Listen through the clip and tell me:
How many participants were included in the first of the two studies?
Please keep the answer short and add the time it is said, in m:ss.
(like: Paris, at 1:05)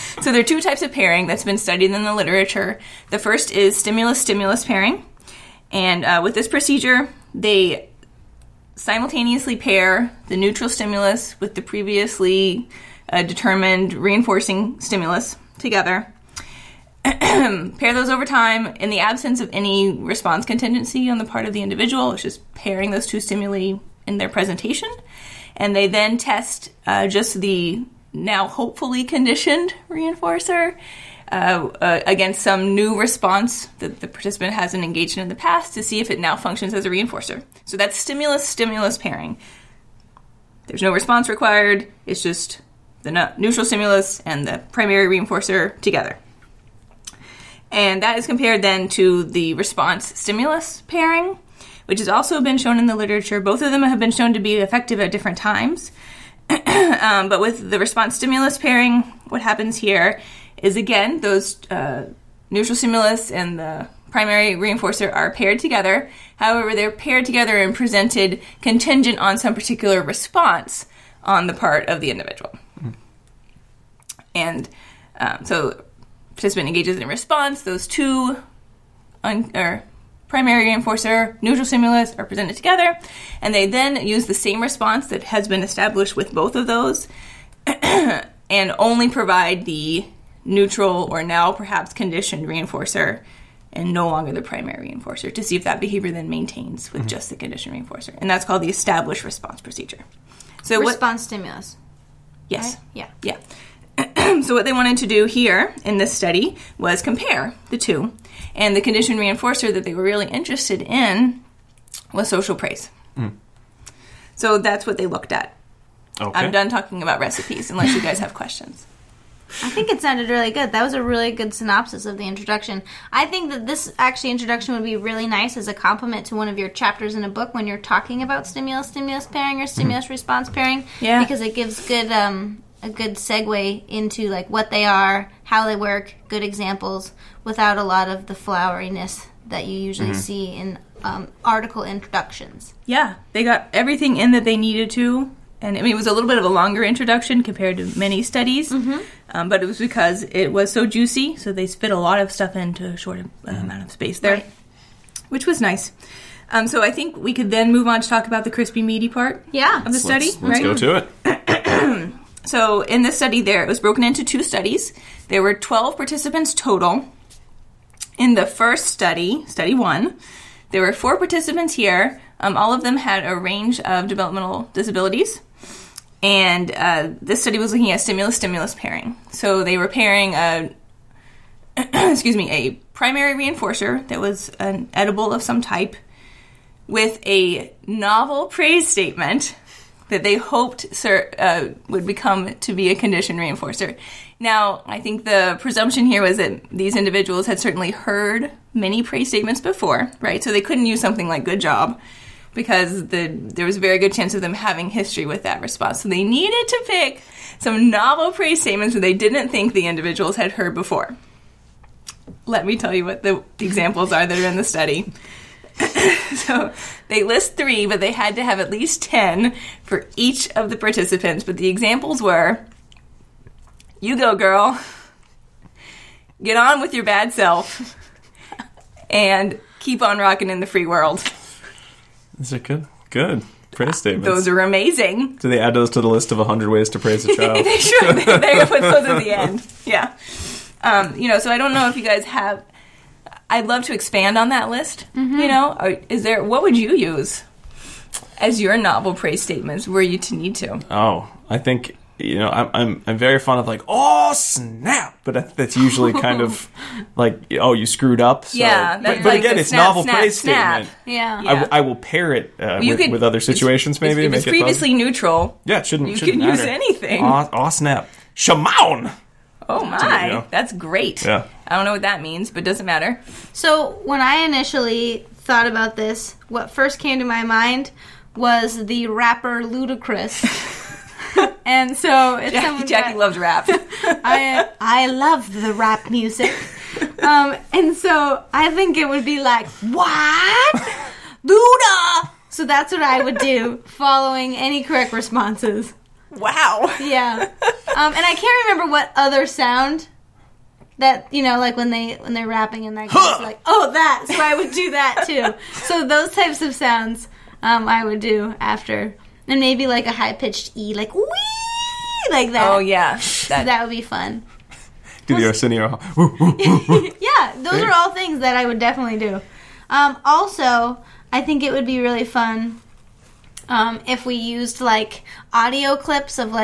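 4, at 2:50.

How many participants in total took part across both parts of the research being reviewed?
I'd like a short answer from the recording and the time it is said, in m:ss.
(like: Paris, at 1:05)
12, at 2:45.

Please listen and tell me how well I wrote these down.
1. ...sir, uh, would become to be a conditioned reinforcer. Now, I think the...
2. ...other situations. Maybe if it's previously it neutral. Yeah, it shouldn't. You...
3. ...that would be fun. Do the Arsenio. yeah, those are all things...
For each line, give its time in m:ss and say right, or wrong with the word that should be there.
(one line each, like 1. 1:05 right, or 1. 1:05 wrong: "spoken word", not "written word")
1. 3:10 right
2. 4:23 right
3. 5:13 right.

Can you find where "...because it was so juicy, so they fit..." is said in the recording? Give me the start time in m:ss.
2:29.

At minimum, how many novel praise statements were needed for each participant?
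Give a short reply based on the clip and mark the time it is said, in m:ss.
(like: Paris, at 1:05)
10, at 3:39.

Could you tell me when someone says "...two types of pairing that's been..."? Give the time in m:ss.
0:00.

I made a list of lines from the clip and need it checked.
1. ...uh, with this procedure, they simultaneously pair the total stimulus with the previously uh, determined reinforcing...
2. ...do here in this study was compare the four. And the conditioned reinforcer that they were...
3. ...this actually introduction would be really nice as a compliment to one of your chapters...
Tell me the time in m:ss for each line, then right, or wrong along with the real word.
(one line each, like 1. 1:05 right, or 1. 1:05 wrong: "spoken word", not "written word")
1. 0:06 wrong: "neutral", not "total"
2. 1:45 wrong: "two", not "four"
3. 2:03 right.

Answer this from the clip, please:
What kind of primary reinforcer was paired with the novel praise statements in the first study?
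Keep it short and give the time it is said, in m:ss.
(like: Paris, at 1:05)
an edible, at 3:04.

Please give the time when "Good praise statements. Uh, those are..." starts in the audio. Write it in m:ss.
3:53.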